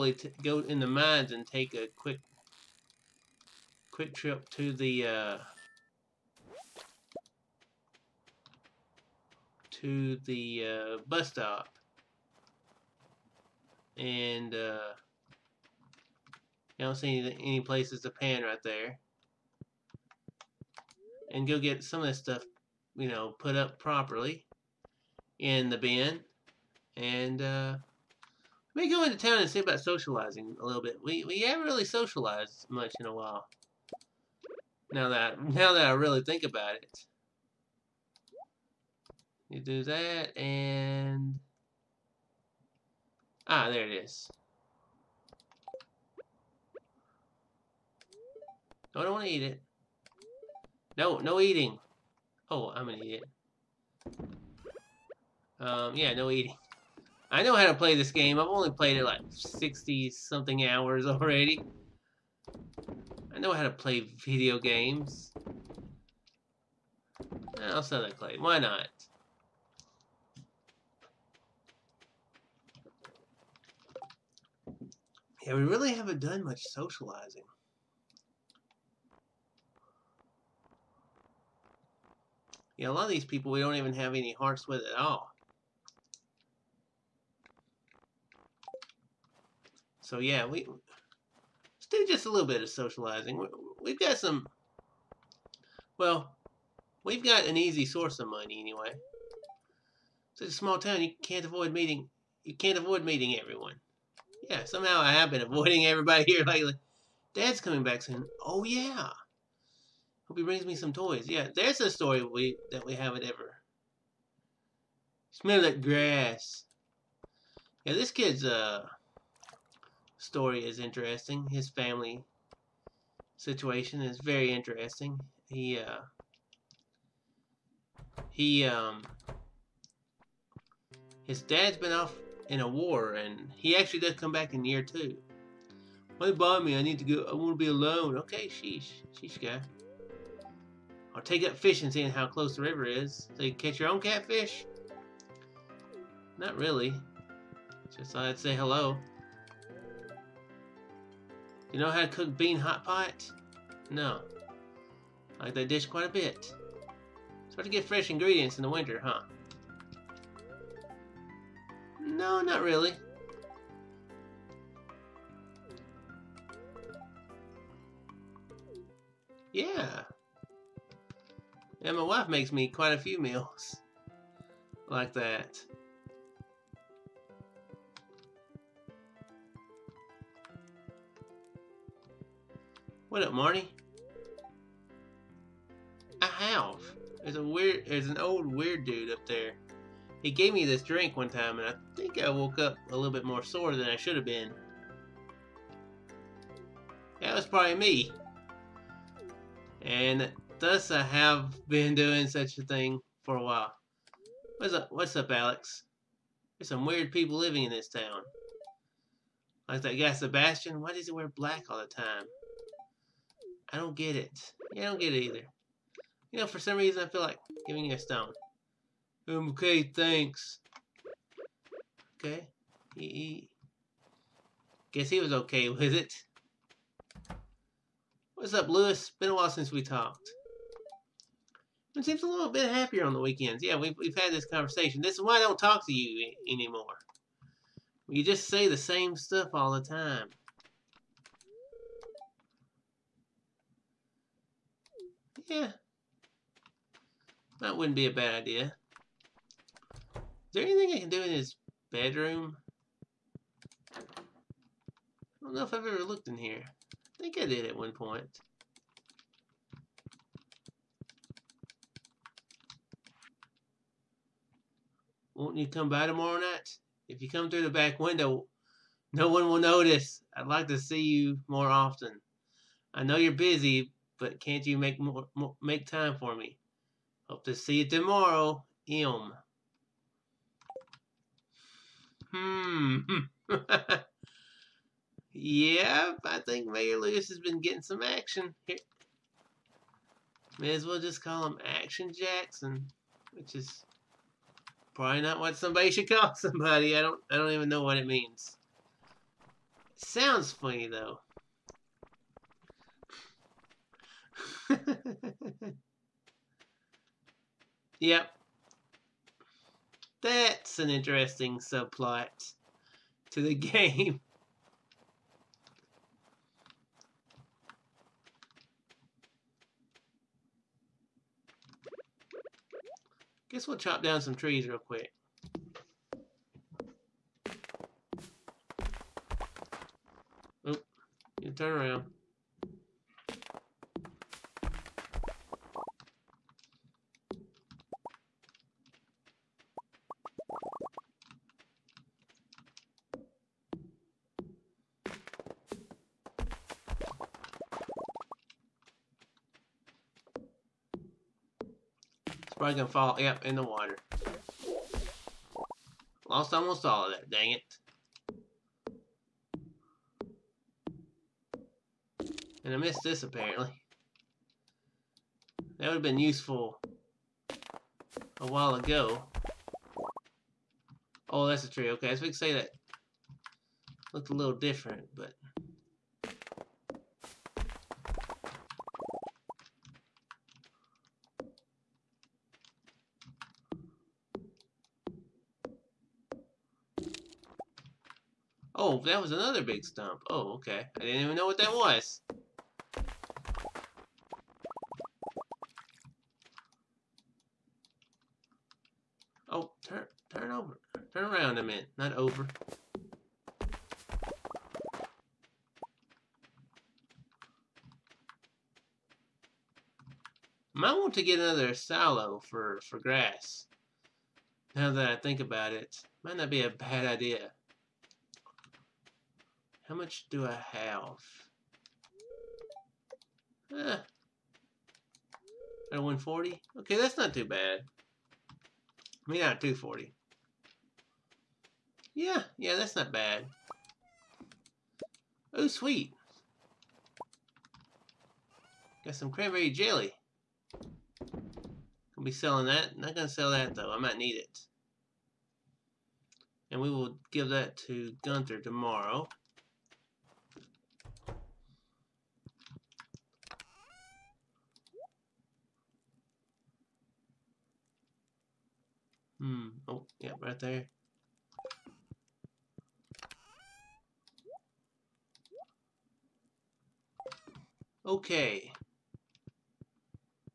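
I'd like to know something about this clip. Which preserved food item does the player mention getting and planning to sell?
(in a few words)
Cranberry jelly.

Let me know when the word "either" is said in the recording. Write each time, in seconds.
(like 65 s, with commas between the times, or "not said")
215 s.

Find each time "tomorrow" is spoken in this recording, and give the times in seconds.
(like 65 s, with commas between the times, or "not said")
266 s, 277 s, 448 s.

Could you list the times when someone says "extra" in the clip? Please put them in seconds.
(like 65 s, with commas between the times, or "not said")
not said.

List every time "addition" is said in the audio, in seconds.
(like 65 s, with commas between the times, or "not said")
not said.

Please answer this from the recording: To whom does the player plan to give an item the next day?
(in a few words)
Gunther.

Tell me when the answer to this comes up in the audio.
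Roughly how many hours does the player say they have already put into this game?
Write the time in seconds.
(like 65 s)
59 s.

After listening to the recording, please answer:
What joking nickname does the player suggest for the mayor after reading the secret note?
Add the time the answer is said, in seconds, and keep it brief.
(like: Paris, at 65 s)
Action Jackson, at 291 s.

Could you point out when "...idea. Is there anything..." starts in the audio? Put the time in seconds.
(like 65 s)
248 s.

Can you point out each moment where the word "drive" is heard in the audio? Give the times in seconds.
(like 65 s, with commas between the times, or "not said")
not said.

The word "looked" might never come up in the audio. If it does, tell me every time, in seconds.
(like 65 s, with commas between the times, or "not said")
256 s, 374 s.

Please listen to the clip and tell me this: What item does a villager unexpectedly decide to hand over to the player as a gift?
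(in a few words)
A stone.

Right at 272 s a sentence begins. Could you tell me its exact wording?
I know you're busy, but can't you make more, more make time for me?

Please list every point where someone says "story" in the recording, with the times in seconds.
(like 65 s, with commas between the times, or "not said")
111 s, 120 s.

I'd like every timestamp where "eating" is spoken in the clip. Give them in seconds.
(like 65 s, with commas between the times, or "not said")
51 s, 56 s.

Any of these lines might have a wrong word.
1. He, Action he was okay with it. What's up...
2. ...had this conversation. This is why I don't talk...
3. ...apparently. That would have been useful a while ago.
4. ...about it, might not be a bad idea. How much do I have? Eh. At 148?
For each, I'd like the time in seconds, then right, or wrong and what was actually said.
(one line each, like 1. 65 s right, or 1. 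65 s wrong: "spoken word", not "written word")
1. 222 s wrong: "Guess", not "Action"
2. 234 s right
3. 363 s right
4. 415 s wrong: "140", not "148".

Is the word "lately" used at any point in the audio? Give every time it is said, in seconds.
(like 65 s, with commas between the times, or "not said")
106 s.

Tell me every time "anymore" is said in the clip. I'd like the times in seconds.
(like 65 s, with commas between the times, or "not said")
236 s.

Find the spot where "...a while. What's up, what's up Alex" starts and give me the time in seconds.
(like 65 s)
203 s.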